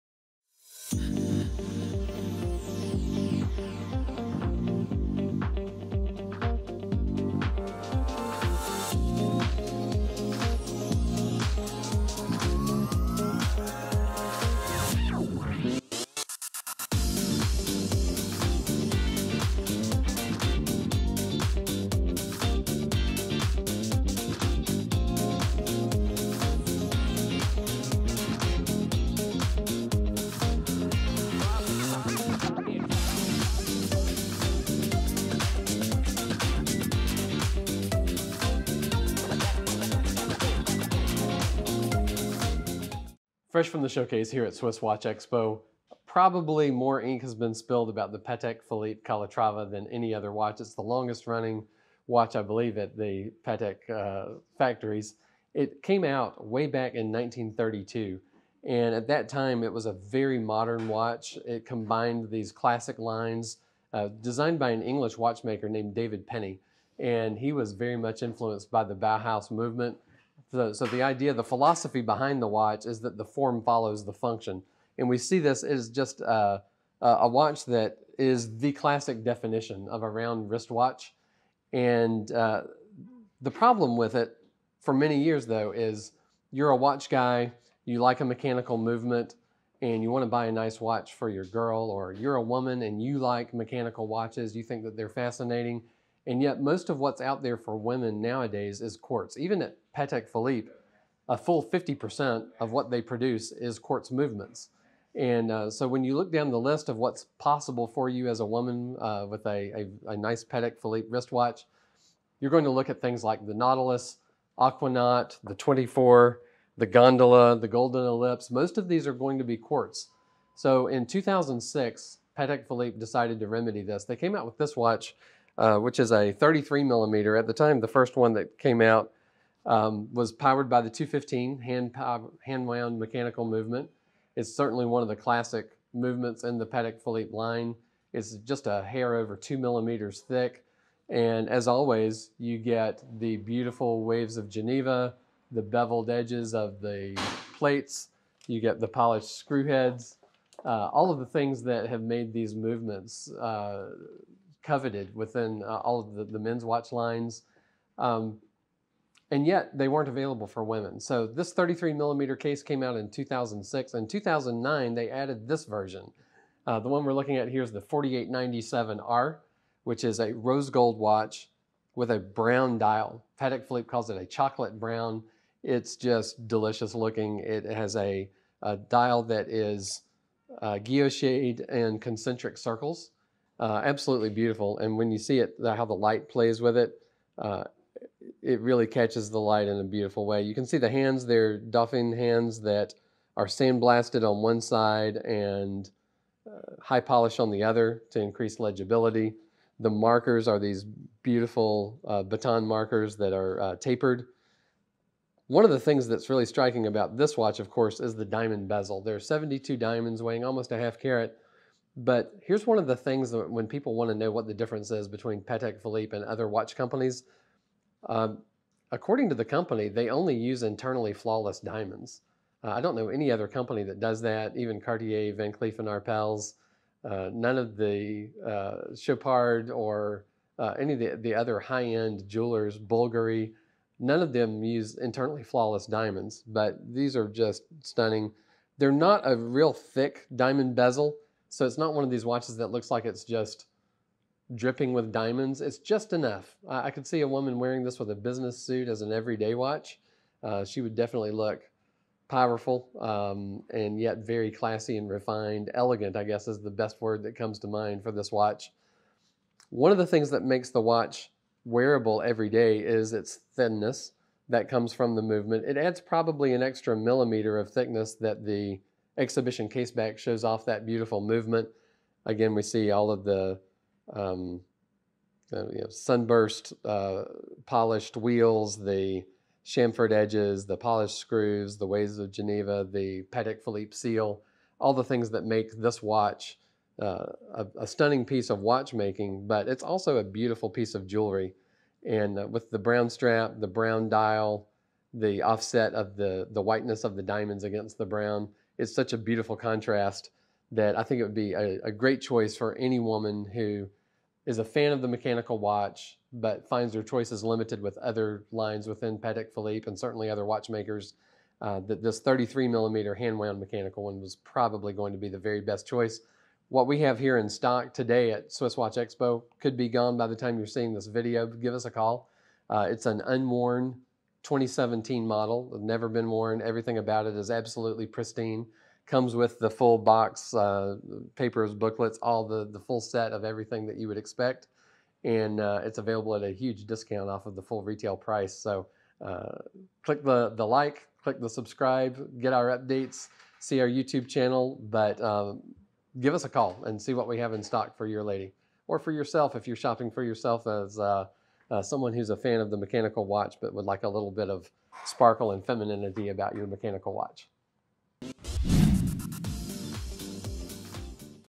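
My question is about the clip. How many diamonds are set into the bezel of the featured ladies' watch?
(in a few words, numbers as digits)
72.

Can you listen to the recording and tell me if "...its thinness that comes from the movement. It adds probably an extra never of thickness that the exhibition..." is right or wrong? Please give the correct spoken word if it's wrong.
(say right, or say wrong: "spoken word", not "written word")
wrong: "millimeter", not "never".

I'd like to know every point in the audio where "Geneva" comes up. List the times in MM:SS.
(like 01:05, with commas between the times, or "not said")
02:24, 04:42.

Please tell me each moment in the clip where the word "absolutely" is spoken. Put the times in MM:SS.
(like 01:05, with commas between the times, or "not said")
03:03, 05:27.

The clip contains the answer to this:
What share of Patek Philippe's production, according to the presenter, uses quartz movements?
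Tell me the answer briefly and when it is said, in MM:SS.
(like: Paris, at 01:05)
50%, at 01:41.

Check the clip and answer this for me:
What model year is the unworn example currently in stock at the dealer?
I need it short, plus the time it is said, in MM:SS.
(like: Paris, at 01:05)
2017, at 05:24.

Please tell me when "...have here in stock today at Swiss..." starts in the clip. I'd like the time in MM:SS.
05:17.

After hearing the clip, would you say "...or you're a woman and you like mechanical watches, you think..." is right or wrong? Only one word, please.
right.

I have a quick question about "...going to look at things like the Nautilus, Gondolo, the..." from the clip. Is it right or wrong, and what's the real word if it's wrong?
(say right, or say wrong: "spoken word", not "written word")
wrong: "Aquanaut", not "Gondolo".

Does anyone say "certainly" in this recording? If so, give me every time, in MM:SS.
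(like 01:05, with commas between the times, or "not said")
02:14, 05:09.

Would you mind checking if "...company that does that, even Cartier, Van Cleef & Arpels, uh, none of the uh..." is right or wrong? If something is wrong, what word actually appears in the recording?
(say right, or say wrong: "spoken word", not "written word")
right.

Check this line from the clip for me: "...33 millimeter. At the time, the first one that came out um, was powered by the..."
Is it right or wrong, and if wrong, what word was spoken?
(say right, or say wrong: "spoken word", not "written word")
right.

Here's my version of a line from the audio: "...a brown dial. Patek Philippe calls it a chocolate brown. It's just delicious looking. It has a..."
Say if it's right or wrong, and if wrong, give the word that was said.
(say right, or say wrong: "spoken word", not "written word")
right.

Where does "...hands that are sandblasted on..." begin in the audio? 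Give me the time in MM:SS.
03:12.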